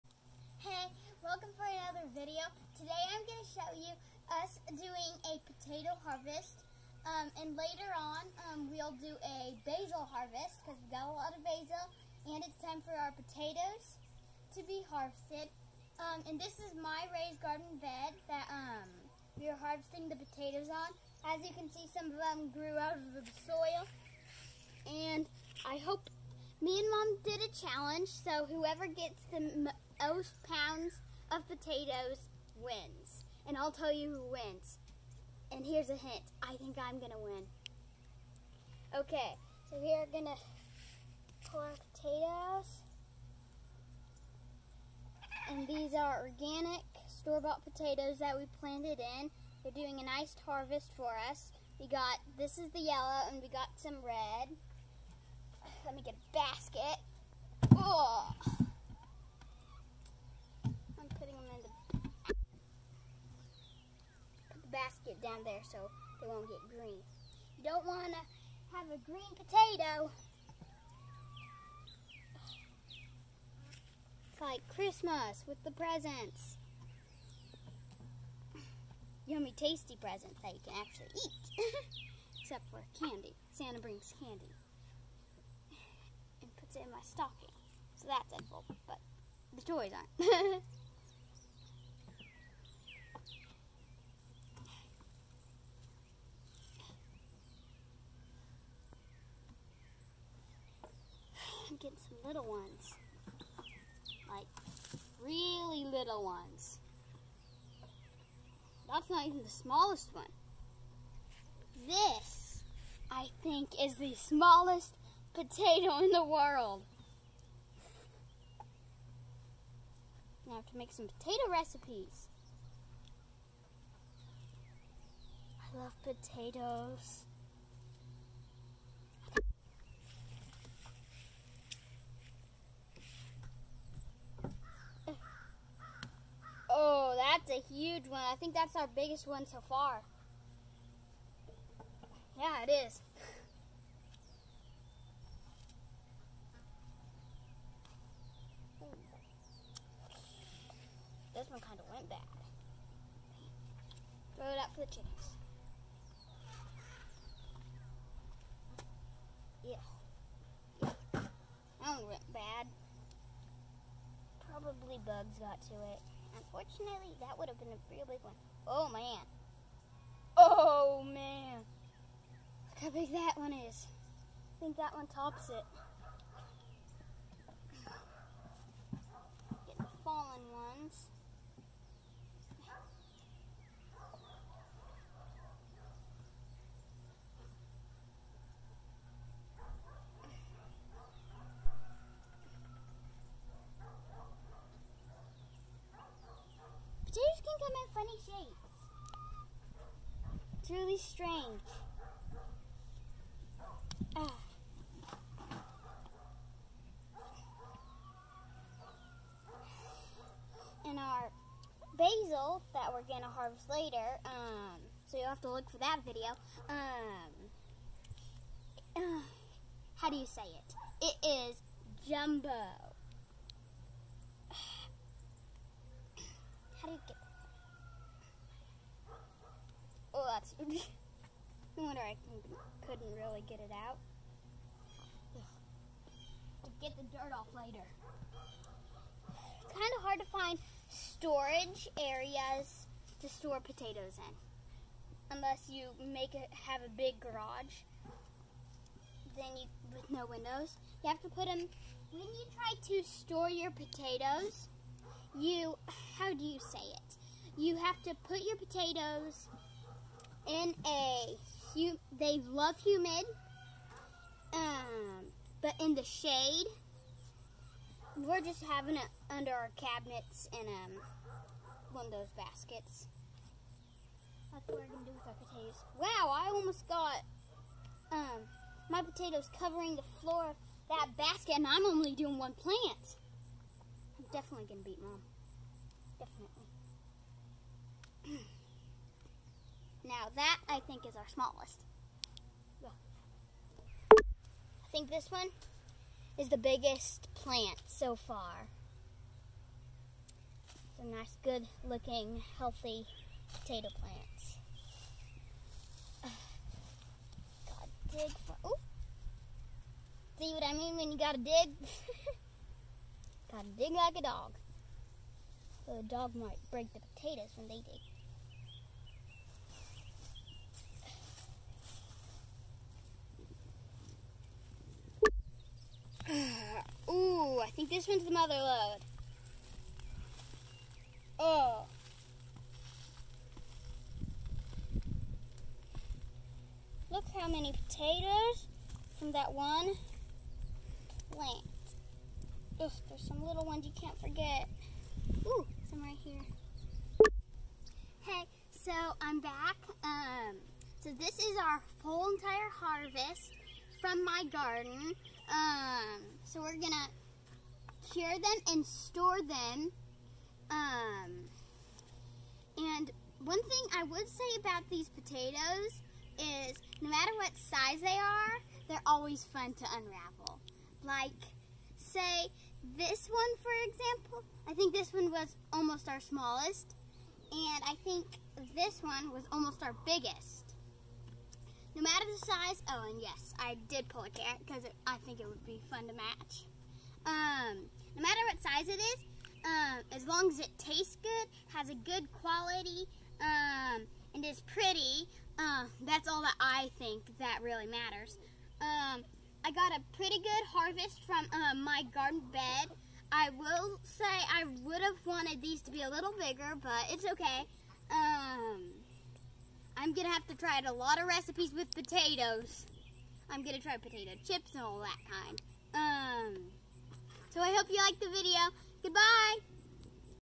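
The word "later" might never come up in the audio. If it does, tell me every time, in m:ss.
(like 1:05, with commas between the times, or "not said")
0:07, 3:33, 3:57.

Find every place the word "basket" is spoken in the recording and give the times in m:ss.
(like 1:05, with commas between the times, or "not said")
0:56, 1:04, 4:32, 4:41.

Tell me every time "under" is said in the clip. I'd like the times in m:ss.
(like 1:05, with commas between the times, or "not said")
4:29.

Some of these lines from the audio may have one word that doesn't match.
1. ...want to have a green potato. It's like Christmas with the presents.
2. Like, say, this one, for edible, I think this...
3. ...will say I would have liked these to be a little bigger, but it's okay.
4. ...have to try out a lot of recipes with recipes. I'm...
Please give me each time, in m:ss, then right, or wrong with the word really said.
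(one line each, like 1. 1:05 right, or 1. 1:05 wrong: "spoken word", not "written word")
1. 1:07 right
2. 6:11 wrong: "example", not "edible"
3. 6:43 wrong: "wanted", not "liked"
4. 6:50 wrong: "potatoes", not "recipes".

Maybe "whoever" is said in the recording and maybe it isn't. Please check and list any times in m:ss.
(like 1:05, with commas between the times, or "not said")
0:28.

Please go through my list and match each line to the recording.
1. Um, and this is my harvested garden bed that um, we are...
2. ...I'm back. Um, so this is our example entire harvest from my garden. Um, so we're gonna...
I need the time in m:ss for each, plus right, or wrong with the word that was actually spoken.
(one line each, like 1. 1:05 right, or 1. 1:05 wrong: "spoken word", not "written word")
1. 0:15 wrong: "raised", not "harvested"
2. 5:49 wrong: "whole", not "example".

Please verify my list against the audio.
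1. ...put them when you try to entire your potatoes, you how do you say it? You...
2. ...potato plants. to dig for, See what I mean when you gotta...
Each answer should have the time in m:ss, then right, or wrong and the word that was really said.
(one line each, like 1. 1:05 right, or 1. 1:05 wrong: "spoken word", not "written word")
1. 4:11 wrong: "store", not "entire"
2. 5:03 right.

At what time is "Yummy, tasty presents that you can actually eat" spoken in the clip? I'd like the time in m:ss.
1:19.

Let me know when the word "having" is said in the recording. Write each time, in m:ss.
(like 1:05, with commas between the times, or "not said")
4:28.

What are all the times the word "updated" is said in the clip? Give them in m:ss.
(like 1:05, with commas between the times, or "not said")
not said.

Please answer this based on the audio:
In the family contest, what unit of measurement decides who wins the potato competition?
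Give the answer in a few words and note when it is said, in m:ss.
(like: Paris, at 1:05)
Pounds, at 0:30.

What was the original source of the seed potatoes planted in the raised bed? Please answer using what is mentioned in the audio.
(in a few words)
Organic store-bought potatoes.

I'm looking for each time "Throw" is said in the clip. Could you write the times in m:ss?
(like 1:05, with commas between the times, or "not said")
2:34.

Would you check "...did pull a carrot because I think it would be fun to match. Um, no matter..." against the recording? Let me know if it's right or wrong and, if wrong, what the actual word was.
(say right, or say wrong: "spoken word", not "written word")
right.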